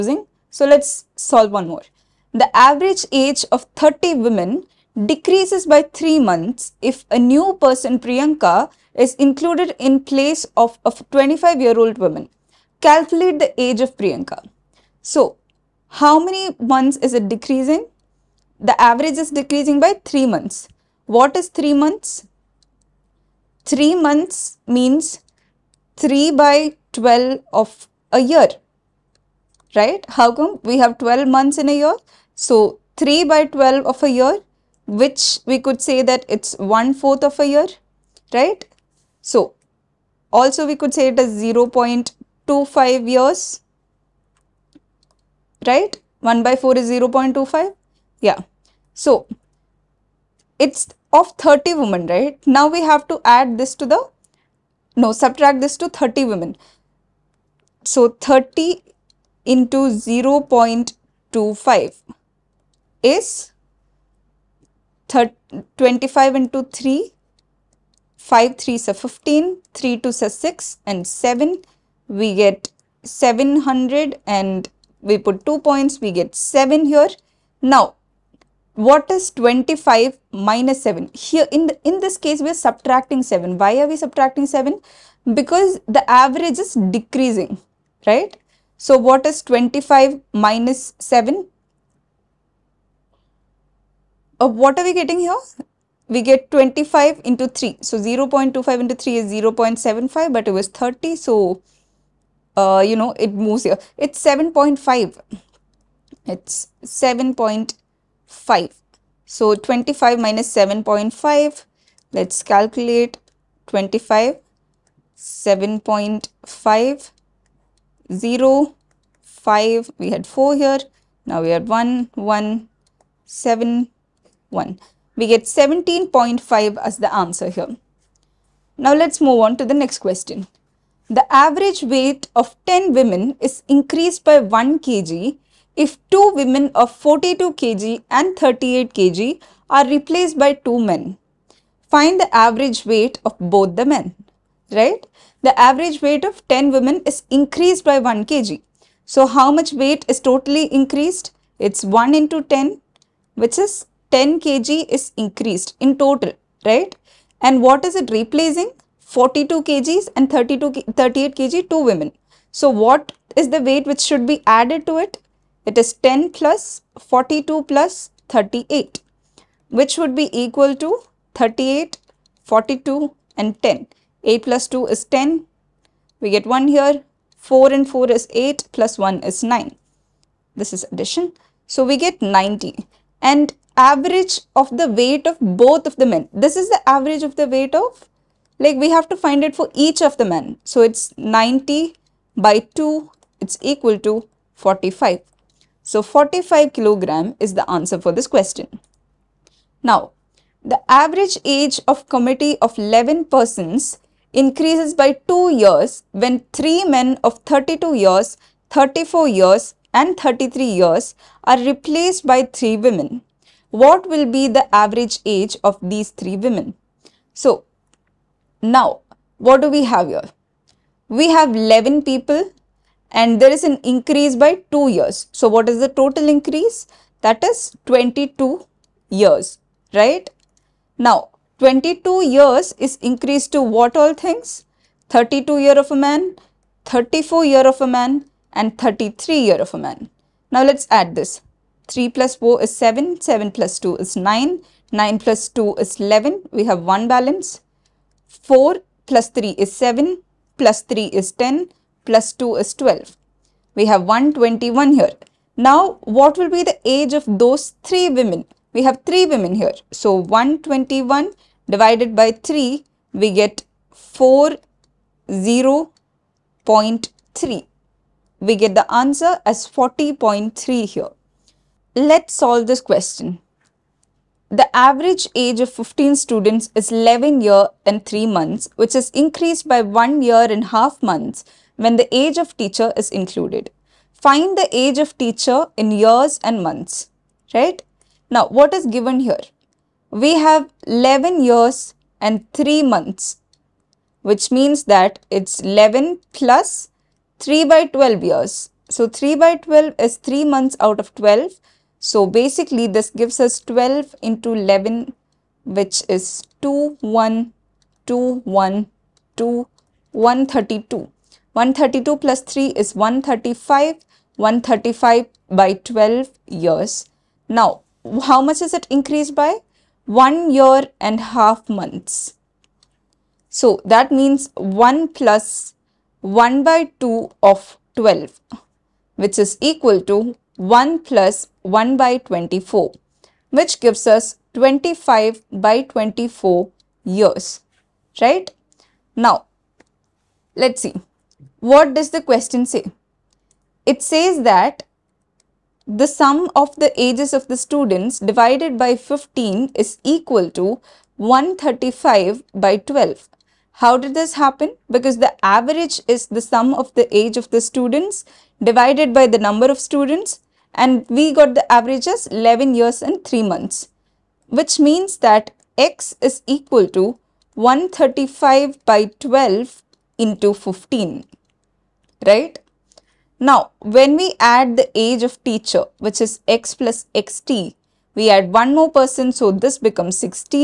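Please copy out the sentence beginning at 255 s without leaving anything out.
Now, what will be the age of those three women?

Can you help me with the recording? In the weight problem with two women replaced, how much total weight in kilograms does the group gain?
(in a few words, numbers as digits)
10 kg.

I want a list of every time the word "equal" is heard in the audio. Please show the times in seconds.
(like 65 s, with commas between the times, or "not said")
170 s, 193 s, 329 s, 350 s, 366 s.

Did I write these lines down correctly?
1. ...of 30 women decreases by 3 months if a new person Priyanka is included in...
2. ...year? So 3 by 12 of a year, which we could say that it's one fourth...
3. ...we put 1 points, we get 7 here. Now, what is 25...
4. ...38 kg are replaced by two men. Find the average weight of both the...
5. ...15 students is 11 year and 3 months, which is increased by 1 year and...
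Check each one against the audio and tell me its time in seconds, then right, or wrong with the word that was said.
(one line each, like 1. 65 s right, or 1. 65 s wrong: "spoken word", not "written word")
1. 3 s right
2. 31 s right
3. 75 s wrong: "2", not "1"
4. 138 s right
5. 275 s right.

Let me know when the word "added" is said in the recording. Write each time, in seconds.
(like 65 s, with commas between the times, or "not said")
164 s.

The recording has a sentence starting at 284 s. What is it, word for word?
Find the age of teacher in years and months, right?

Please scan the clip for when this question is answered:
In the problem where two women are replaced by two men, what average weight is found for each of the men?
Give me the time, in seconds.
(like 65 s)
196 s.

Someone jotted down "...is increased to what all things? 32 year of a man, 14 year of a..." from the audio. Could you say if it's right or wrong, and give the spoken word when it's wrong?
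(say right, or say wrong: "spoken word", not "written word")
wrong: "34", not "14".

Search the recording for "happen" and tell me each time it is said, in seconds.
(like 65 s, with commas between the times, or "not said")
354 s.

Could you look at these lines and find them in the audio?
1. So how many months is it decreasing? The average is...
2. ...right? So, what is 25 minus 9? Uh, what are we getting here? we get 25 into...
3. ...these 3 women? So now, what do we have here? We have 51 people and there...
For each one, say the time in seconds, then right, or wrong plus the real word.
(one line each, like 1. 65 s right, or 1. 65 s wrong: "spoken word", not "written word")
1. 15 s right
2. 88 s wrong: "7", not "9"
3. 215 s wrong: "11", not "51".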